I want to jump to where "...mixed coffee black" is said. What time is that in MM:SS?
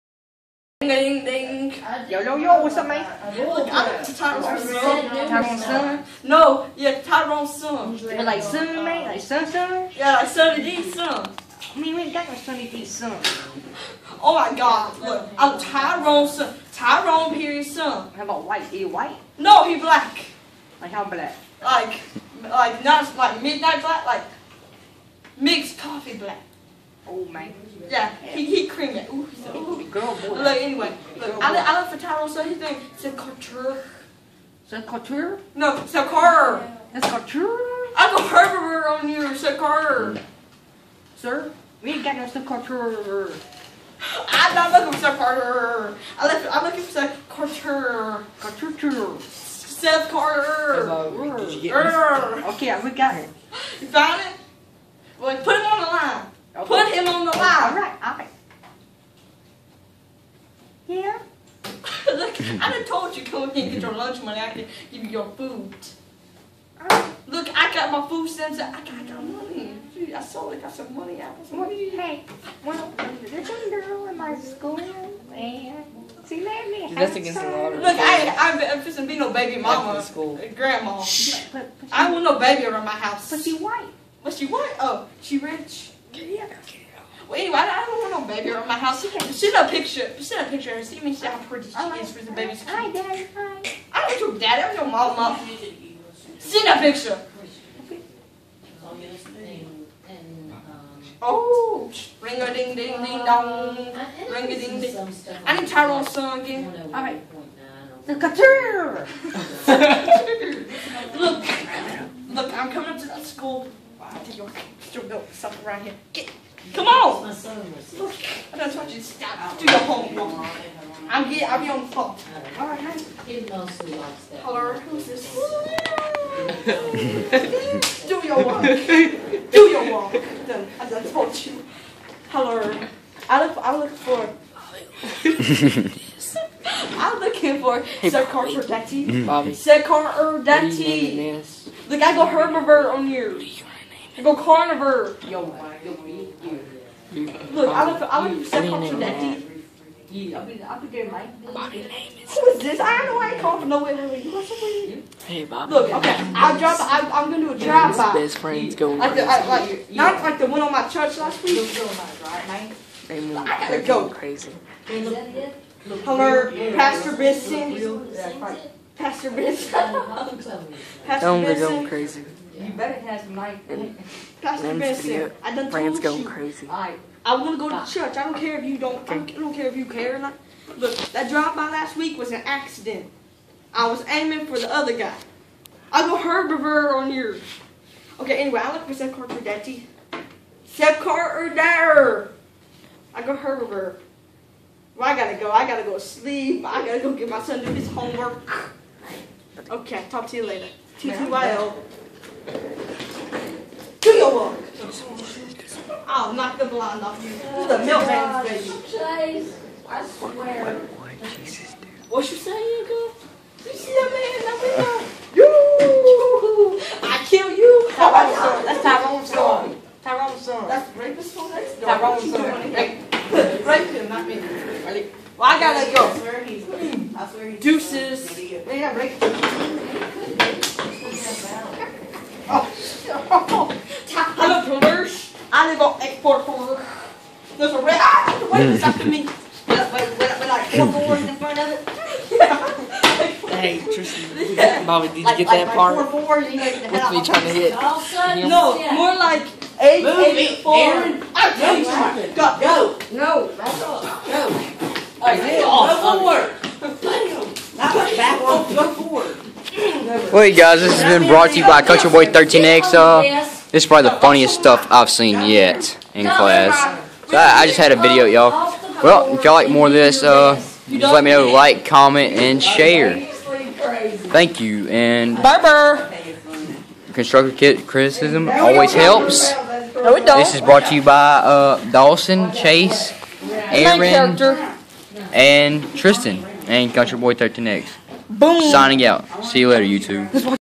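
00:25.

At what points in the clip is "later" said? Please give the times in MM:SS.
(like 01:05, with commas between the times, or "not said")
03:20, 04:49.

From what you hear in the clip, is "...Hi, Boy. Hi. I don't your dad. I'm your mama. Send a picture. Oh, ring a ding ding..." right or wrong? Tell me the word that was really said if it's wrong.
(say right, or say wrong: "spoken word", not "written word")
wrong: "Daddy", not "Boy".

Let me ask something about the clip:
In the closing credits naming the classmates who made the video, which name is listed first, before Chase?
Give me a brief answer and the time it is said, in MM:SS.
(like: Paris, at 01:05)
Dawson, at 04:41.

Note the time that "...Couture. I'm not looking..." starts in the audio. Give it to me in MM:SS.
00:42.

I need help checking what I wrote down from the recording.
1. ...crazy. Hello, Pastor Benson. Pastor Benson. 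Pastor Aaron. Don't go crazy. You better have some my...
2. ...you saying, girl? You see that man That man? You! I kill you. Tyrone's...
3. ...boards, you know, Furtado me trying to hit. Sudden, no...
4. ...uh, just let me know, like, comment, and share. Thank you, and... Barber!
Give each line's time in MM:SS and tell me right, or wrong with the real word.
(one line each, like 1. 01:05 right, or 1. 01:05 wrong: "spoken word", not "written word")
1. 02:44 wrong: "Benson", not "Aaron"
2. 03:32 right
3. 04:06 wrong: "With", not "Furtado"
4. 04:30 right.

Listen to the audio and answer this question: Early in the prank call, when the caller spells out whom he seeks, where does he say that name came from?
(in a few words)
Alan Furtado.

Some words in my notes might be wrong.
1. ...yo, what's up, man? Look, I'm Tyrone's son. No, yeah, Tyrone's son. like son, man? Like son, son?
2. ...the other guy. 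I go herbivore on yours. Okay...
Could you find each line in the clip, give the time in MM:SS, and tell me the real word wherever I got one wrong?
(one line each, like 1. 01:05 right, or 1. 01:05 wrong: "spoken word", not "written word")
1. 00:02 right
2. 03:04 right.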